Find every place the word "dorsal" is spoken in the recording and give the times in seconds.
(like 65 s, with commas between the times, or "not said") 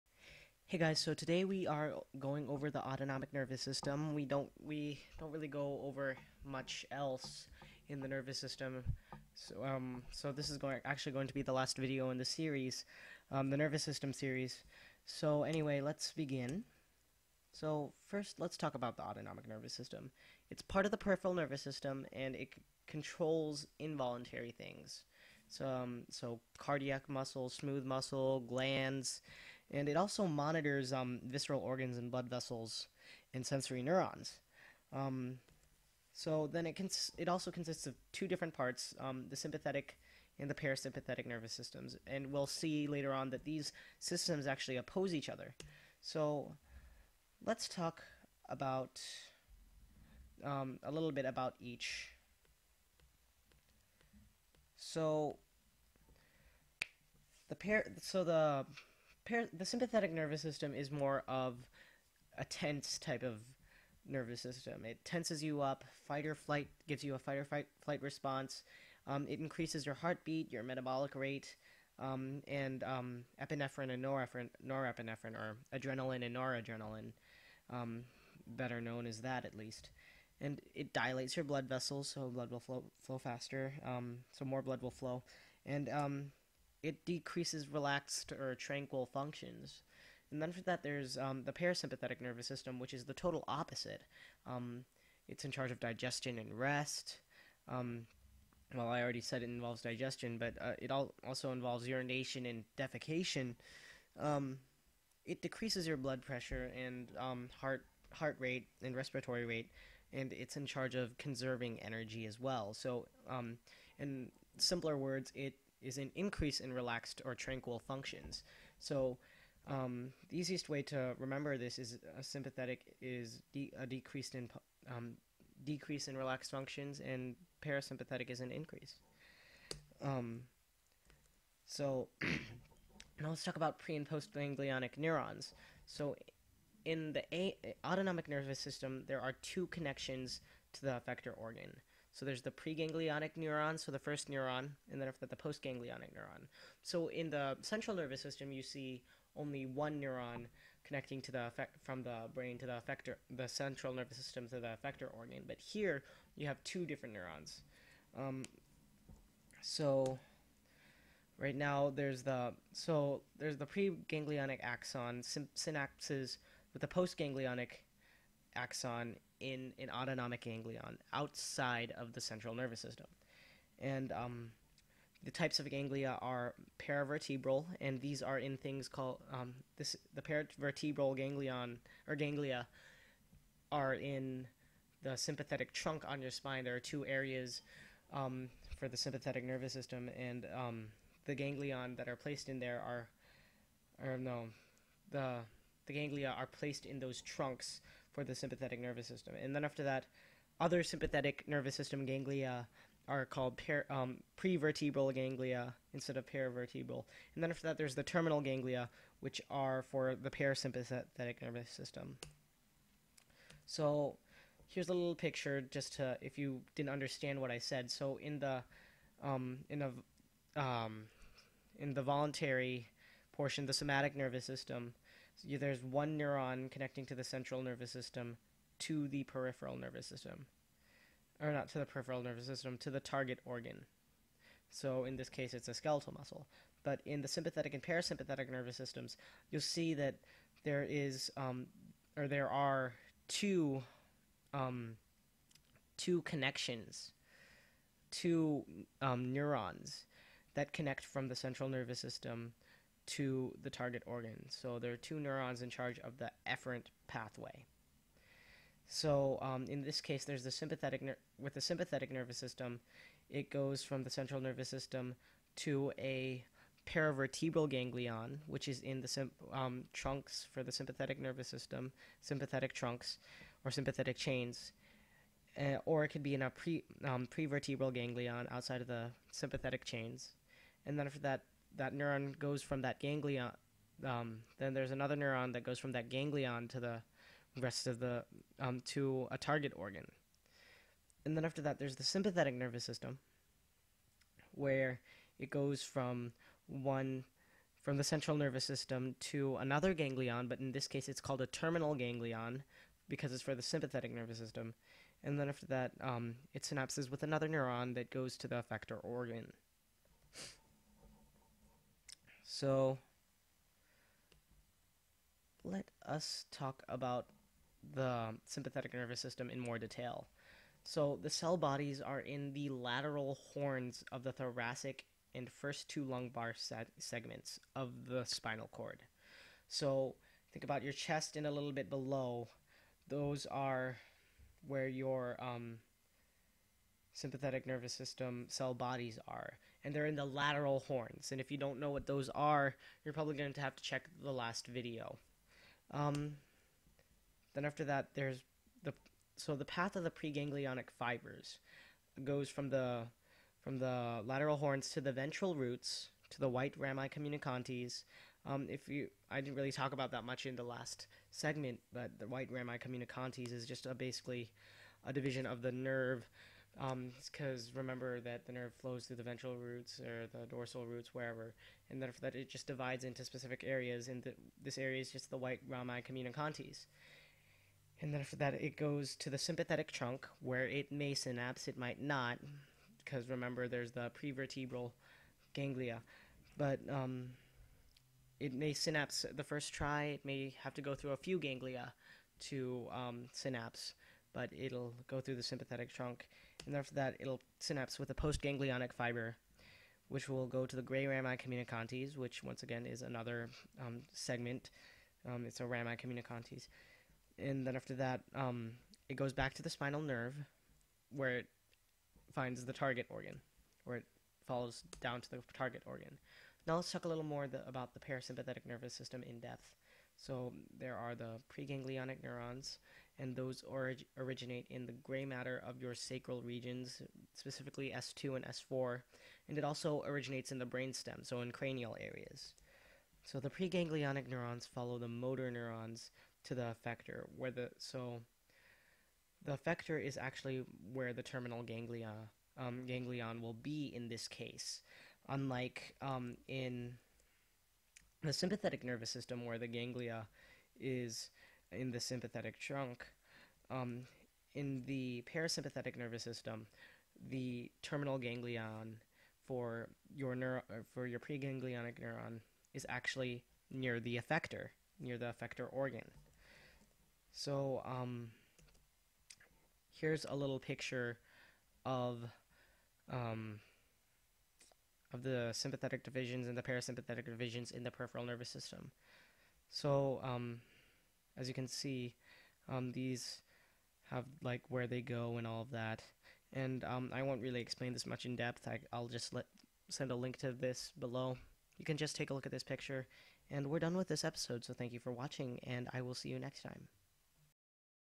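370 s.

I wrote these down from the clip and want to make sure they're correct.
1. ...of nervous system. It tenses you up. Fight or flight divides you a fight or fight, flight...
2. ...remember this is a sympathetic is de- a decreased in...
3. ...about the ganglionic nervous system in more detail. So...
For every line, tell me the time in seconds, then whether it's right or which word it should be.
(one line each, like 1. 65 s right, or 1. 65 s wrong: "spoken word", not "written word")
1. 63 s wrong: "gives", not "divides"
2. 121 s right
3. 316 s wrong: "sympathetic", not "ganglionic".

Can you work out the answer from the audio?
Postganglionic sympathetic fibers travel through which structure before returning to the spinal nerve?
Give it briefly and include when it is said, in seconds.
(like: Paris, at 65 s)
Gray rami communicantes, at 400 s.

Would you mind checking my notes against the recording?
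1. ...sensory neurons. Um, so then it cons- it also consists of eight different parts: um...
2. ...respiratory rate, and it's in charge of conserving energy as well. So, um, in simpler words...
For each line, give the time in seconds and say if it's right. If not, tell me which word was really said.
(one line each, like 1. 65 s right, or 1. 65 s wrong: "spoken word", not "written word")
1. 33 s wrong: "two", not "eight"
2. 108 s right.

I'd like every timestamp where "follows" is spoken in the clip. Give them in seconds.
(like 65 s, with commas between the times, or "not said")
414 s, 434 s.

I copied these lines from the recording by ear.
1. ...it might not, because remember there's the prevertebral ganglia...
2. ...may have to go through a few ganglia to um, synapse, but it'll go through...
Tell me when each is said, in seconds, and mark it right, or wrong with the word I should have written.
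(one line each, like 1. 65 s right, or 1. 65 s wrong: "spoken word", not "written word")
1. 381 s right
2. 390 s right.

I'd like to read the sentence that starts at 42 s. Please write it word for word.
And we'll see later on that these systems actually oppose each other.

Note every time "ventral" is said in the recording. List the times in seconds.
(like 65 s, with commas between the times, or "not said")
355 s, 369 s.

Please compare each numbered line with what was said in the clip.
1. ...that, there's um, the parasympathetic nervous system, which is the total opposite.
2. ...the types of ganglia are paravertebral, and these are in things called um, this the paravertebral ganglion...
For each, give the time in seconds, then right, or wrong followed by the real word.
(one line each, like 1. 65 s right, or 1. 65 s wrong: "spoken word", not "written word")
1. 90 s right
2. 175 s right.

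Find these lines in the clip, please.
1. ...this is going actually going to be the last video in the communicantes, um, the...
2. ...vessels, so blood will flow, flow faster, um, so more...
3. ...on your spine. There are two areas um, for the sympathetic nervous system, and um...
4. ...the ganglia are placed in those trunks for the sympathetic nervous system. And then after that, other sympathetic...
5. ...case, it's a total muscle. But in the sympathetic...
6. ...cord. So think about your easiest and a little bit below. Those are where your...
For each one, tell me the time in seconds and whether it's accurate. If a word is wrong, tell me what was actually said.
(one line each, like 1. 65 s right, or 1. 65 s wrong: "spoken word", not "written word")
1. 10 s wrong: "series", not "communicantes"
2. 81 s right
3. 186 s right
4. 195 s right
5. 235 s wrong: "skeletal", not "total"
6. 328 s wrong: "chest", not "easiest".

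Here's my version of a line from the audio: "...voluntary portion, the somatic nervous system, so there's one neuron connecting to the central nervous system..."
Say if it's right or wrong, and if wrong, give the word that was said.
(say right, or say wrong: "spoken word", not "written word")
right.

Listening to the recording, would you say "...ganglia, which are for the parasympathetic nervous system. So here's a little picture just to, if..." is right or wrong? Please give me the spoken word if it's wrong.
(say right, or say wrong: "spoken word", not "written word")
right.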